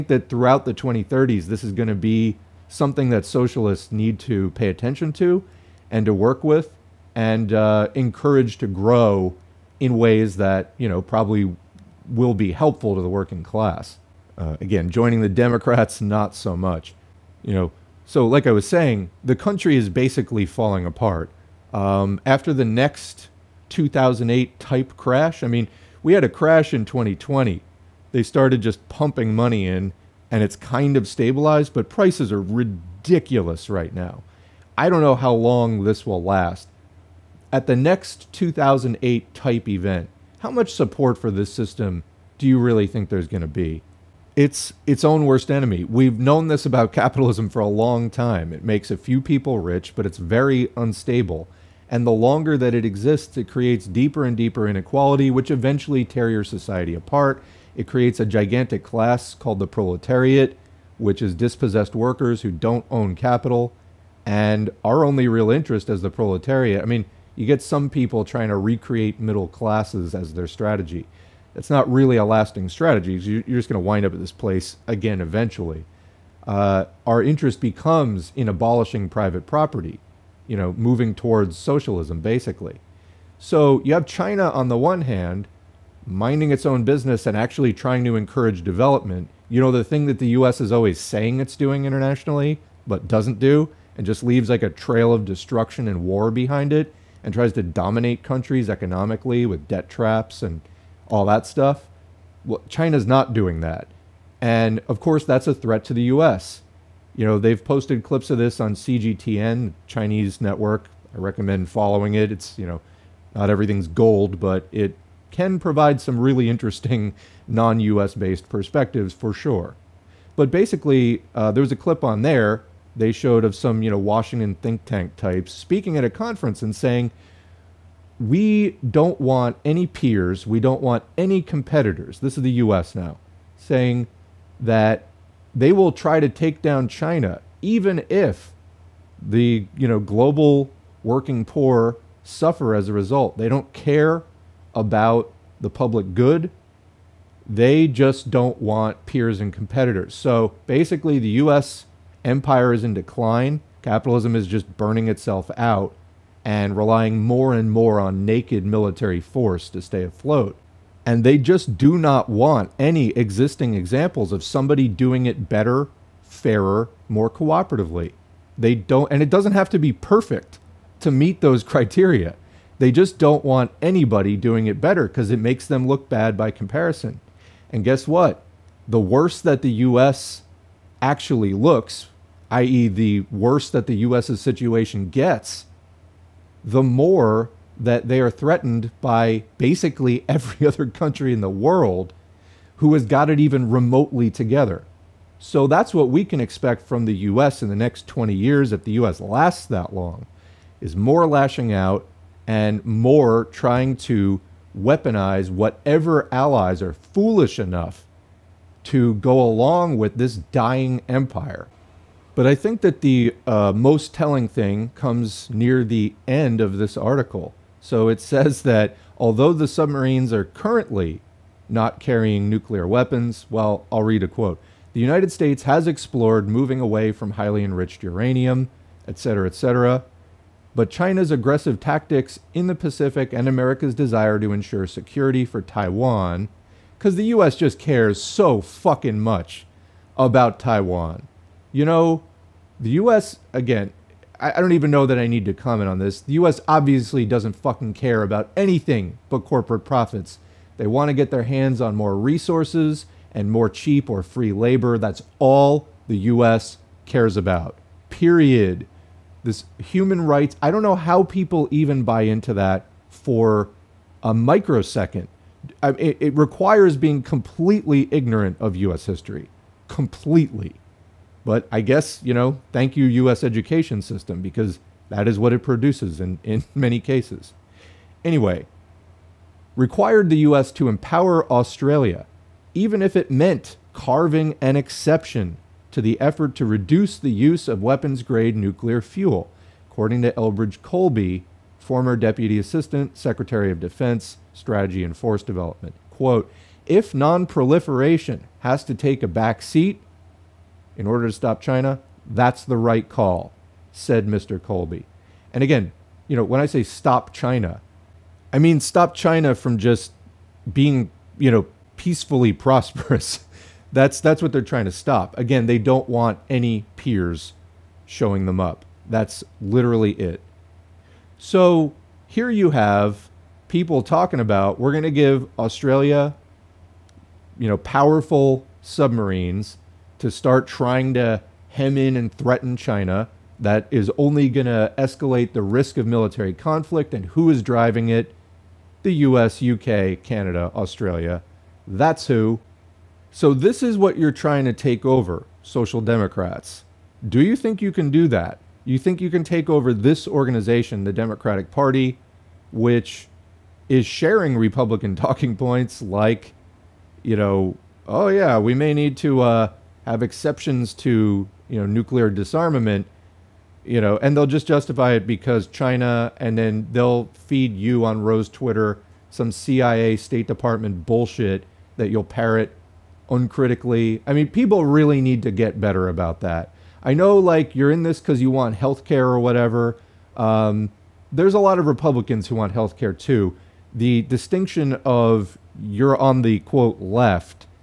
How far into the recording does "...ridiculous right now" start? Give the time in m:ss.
0:32.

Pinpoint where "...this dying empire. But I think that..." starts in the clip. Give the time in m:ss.
3:30.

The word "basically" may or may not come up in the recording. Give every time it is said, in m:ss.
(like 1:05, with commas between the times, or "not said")
0:19, 1:22, 2:00, 2:30, 3:09.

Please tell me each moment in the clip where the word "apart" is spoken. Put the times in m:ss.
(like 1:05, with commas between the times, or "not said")
0:20, 0:56.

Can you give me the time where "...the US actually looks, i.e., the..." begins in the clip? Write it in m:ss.
2:59.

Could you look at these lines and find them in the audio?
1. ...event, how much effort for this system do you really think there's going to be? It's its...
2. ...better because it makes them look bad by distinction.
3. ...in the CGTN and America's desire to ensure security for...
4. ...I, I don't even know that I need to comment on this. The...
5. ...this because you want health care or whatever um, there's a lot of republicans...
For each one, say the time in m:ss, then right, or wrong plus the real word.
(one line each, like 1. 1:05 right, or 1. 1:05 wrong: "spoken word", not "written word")
1. 0:39 wrong: "support", not "effort"
2. 2:54 wrong: "comparison", not "distinction"
3. 3:52 wrong: "Pacific", not "CGTN"
4. 4:04 right
5. 6:18 right.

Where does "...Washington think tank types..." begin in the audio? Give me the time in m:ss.
2:03.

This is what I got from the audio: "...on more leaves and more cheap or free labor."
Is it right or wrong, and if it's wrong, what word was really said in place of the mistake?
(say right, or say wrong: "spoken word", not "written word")
wrong: "resources", not "leaves".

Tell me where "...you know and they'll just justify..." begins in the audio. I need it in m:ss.
6:03.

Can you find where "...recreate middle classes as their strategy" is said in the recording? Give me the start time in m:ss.
1:08.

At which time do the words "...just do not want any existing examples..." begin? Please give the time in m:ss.
2:41.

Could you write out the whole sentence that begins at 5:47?
Do you think you can do that?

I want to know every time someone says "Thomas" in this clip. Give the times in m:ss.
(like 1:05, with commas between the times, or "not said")
not said.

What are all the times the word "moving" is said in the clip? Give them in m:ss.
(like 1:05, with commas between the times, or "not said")
1:20, 3:46.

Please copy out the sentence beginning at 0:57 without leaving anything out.
It creates a gigantic class called the proletariat, which is dispossessed workers who don't own capital.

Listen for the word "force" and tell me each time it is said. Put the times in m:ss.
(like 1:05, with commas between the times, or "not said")
2:39, 4:55.